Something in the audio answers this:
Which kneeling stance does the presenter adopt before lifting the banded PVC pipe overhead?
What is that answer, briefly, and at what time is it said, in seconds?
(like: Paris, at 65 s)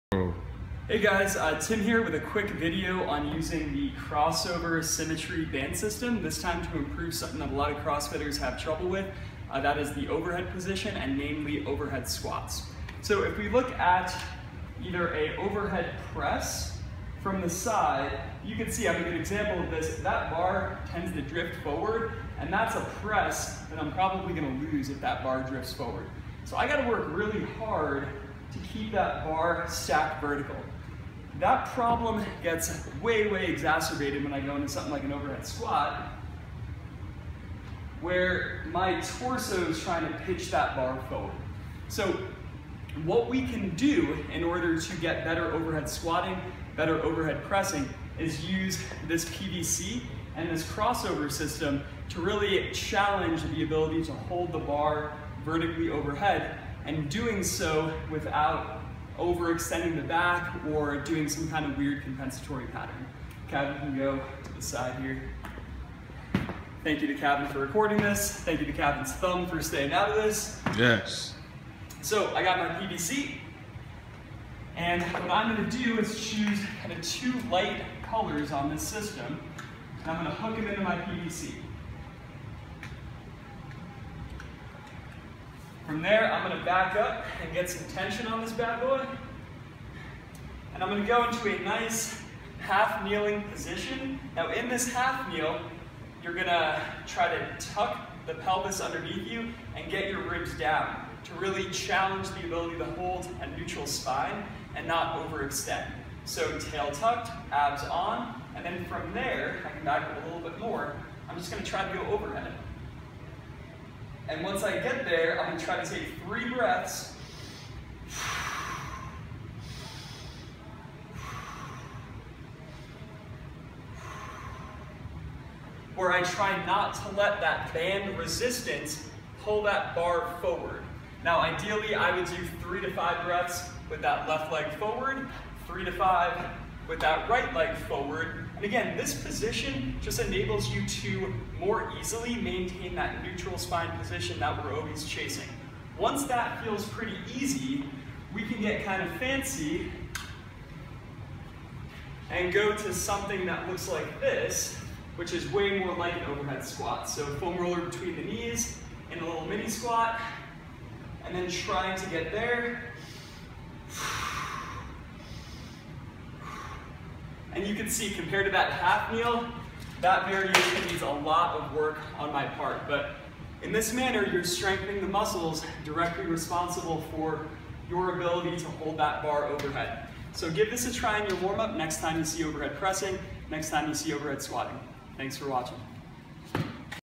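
Half kneeling, at 92 s.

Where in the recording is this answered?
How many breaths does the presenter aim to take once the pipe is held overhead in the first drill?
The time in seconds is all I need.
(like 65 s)
116 s.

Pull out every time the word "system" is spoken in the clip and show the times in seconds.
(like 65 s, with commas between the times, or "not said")
5 s, 51 s, 78 s.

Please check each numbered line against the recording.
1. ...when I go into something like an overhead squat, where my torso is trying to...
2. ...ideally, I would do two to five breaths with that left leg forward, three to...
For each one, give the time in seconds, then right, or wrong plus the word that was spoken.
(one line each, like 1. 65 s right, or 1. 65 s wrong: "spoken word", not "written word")
1. 34 s right
2. 131 s wrong: "three", not "two".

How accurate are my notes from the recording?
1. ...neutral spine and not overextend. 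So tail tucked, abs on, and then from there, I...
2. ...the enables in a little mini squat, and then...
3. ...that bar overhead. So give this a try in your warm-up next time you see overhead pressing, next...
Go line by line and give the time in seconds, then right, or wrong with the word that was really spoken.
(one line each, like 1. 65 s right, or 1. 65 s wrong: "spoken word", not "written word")
1. 103 s right
2. 158 s wrong: "knees", not "enables"
3. 178 s right.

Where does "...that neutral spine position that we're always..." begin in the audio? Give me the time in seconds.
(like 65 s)
142 s.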